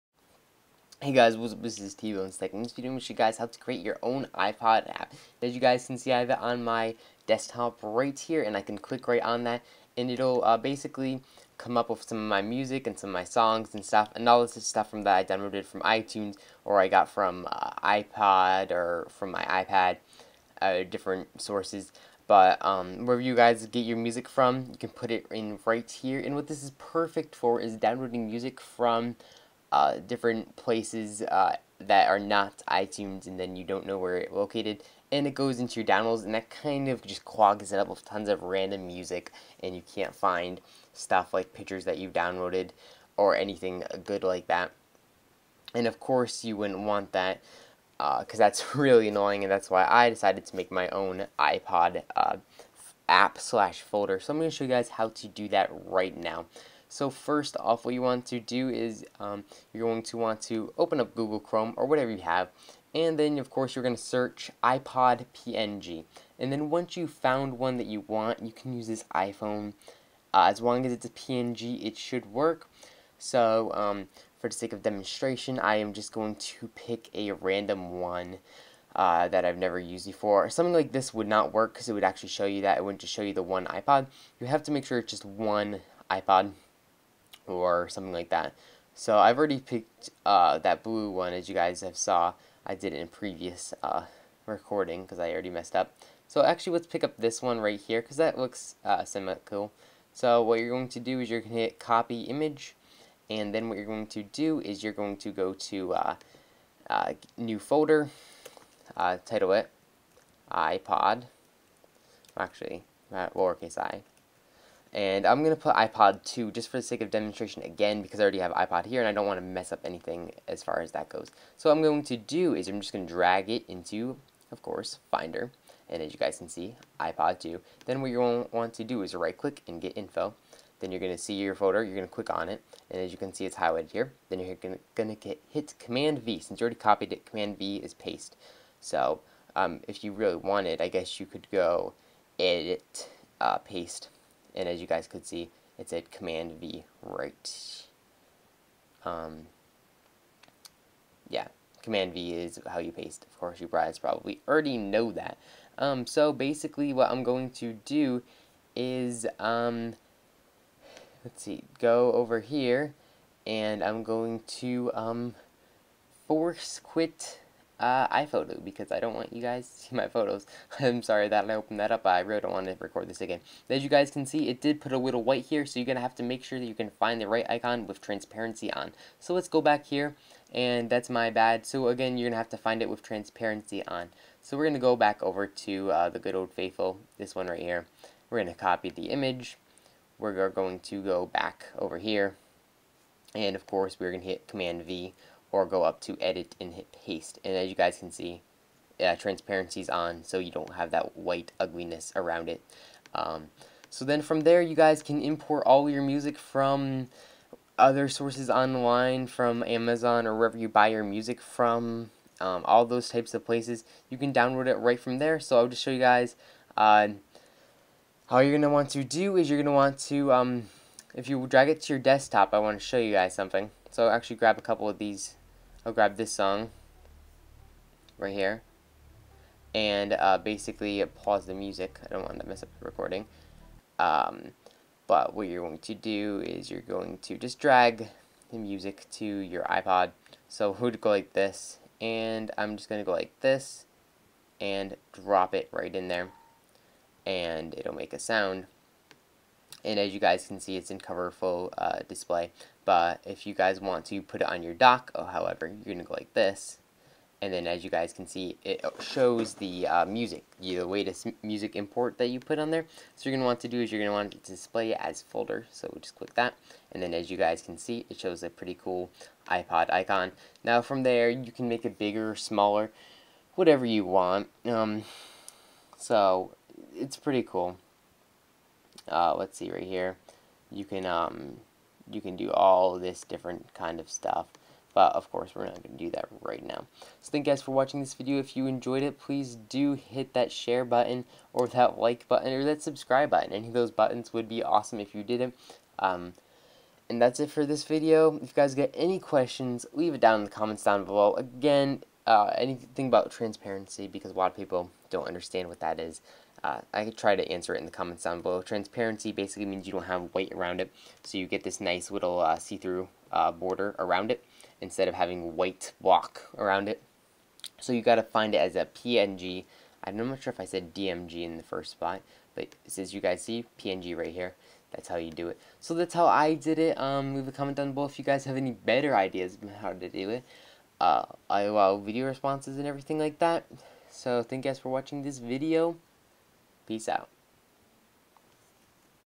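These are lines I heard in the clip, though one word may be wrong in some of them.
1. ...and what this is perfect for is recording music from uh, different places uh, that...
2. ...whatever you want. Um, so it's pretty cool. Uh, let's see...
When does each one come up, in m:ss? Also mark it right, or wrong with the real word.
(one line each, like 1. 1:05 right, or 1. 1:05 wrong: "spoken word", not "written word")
1. 0:26 wrong: "downloading", not "recording"
2. 4:33 right.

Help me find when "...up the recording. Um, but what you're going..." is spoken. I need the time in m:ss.
3:52.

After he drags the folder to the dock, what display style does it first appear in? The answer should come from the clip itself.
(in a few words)
Cover Flow.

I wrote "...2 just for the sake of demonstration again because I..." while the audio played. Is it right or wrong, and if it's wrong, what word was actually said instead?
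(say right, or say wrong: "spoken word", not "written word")
right.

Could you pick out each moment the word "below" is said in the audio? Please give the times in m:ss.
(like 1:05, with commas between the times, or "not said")
5:01, 5:08, 5:27.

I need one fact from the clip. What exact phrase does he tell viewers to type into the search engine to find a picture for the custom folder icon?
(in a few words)
iPod PNG.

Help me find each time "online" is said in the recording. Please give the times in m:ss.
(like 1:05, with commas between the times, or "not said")
3:28.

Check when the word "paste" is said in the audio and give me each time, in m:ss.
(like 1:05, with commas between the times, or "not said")
2:17, 2:23, 2:32, 3:17.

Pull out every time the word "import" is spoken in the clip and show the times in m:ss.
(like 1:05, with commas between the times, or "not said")
3:25, 4:21.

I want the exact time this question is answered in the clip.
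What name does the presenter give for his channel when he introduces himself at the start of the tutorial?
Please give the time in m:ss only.
0:01.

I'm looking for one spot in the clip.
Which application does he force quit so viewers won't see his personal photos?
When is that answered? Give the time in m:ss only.
2:48.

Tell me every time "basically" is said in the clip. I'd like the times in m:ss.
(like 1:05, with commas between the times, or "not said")
0:10, 2:36, 3:50, 5:09.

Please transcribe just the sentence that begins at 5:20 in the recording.
I'm not sure if I said DMG in the first spot, but as you guys see, PNG right here.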